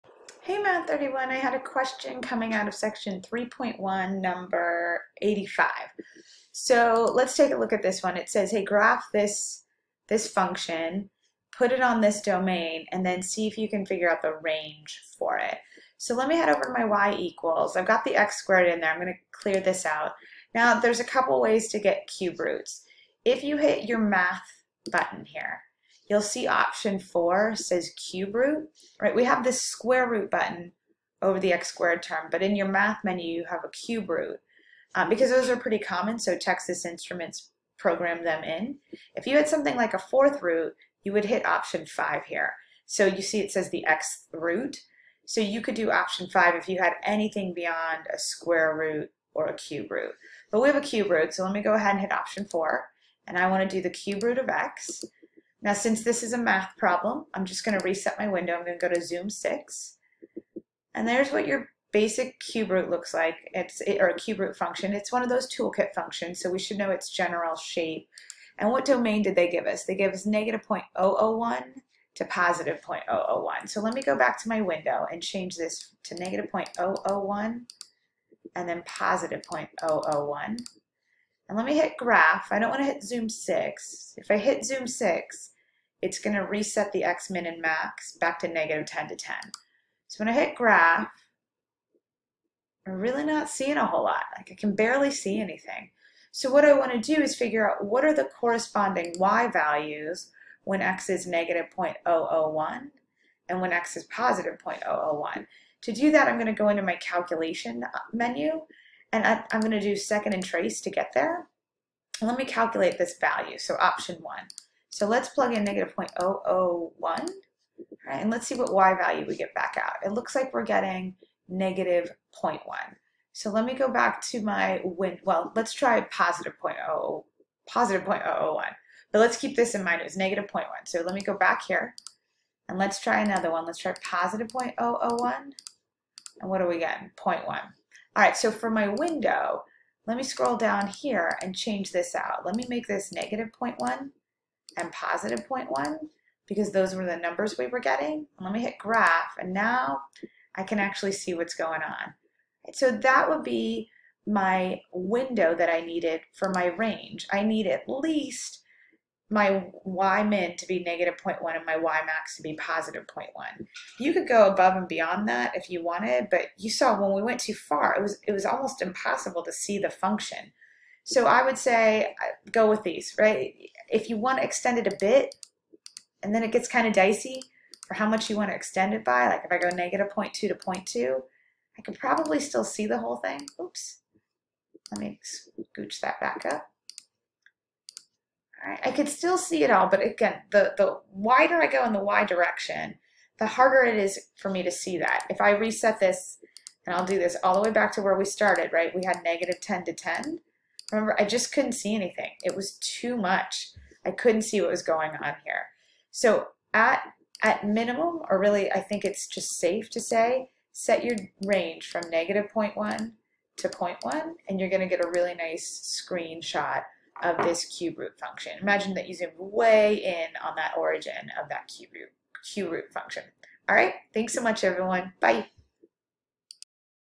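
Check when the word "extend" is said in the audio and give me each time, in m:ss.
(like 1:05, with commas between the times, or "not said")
2:54, 2:58.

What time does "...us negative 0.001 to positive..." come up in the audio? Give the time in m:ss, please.
1:10.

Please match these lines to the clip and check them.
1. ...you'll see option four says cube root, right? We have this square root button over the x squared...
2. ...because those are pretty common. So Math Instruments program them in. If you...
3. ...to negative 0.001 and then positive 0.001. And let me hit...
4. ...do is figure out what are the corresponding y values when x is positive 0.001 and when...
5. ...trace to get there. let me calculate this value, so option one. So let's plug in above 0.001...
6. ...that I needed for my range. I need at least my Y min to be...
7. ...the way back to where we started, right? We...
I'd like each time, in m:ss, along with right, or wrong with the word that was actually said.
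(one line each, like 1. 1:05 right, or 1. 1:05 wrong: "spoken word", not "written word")
1. 0:26 right
2. 0:35 wrong: "Texas", not "Math"
3. 1:16 right
4. 1:37 wrong: "negative", not "positive"
5. 1:50 wrong: "negative", not "above"
6. 2:35 right
7. 3:17 right.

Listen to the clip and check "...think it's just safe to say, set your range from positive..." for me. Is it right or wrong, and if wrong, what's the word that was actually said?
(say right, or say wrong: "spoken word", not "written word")
wrong: "negative", not "positive".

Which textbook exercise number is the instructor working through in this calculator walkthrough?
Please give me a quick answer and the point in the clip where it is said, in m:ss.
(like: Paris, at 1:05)
85, at 0:04.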